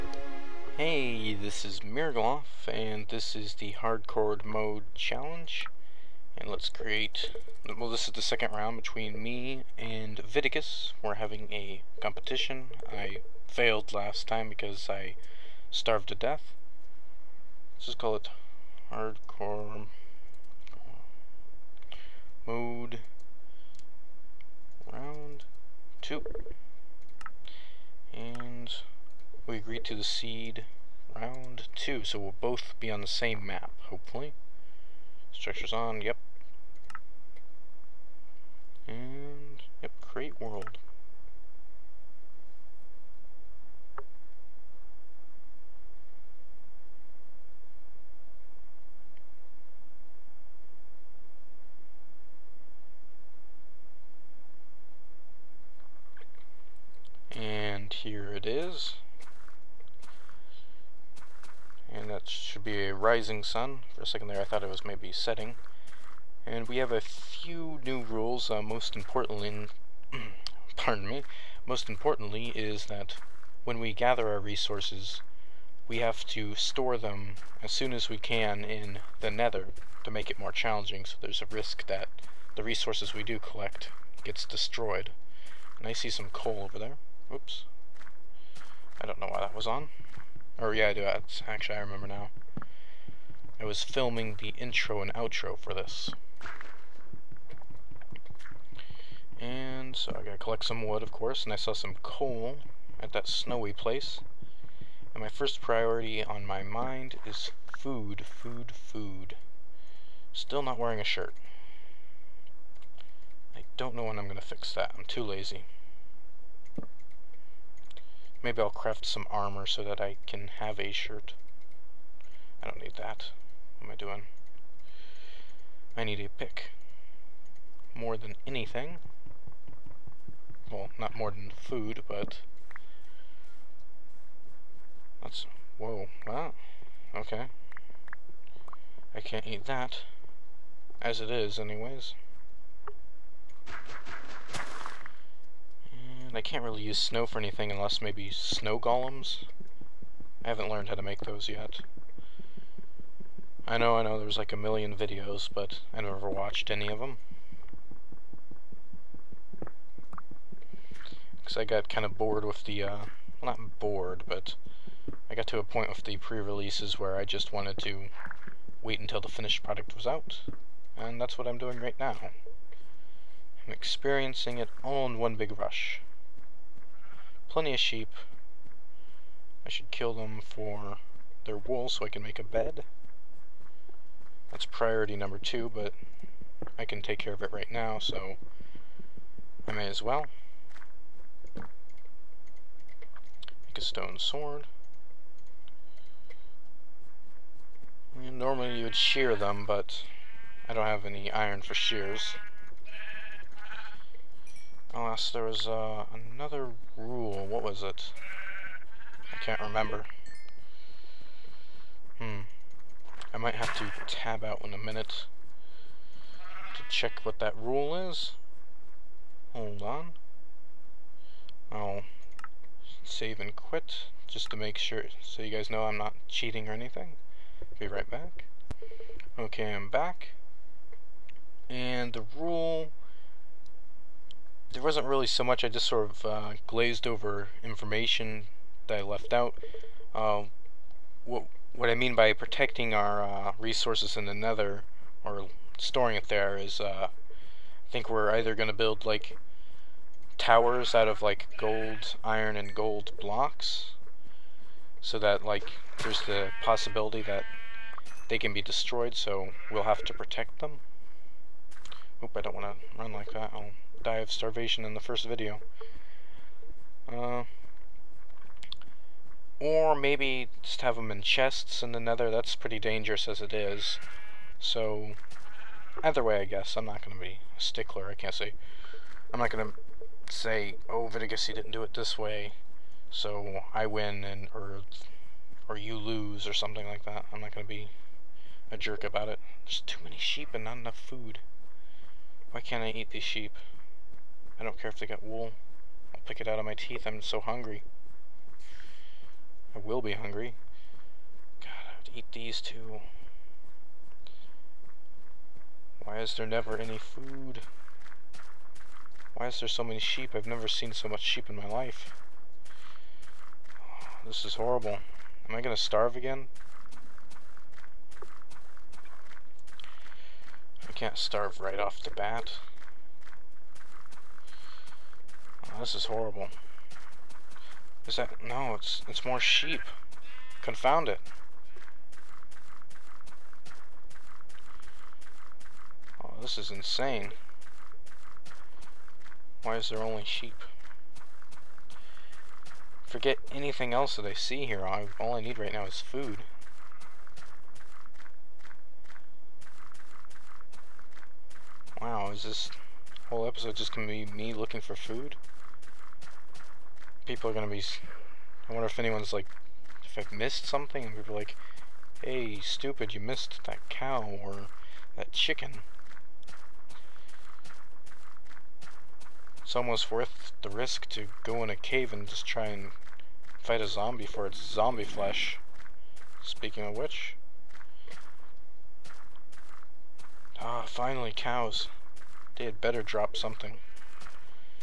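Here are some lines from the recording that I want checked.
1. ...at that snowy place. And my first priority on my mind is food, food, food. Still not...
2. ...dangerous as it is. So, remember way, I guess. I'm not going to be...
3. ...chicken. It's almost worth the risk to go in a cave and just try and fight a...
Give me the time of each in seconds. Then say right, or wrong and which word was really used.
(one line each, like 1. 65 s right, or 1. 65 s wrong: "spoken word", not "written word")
1. 102 s right
2. 272 s wrong: "either", not "remember"
3. 365 s right.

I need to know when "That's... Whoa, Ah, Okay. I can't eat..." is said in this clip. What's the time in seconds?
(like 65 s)
135 s.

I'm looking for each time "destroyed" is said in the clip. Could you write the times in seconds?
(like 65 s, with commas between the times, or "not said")
84 s, 258 s.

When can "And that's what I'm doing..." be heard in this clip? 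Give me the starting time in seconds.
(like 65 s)
170 s.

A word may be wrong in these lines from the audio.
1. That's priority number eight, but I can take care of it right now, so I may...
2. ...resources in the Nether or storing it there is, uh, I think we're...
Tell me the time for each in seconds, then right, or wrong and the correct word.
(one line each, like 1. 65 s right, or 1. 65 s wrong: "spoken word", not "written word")
1. 184 s wrong: "two", not "eight"
2. 243 s right.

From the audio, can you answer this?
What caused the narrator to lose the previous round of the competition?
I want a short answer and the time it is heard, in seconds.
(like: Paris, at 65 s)
starved to death, at 15 s.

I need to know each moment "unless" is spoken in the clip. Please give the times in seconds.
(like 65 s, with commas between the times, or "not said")
147 s, 204 s.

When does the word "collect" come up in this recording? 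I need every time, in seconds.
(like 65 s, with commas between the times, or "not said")
83 s, 100 s.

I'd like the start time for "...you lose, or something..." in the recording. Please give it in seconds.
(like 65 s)
285 s.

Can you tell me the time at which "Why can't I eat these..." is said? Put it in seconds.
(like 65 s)
292 s.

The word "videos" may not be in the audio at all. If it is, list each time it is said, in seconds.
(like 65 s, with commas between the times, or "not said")
154 s, 265 s.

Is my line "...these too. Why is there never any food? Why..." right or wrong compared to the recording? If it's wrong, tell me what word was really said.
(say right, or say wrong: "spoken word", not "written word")
right.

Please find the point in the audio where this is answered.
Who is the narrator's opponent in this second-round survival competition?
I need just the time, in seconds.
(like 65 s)
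10 s.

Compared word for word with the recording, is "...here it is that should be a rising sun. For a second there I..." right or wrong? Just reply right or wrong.
right.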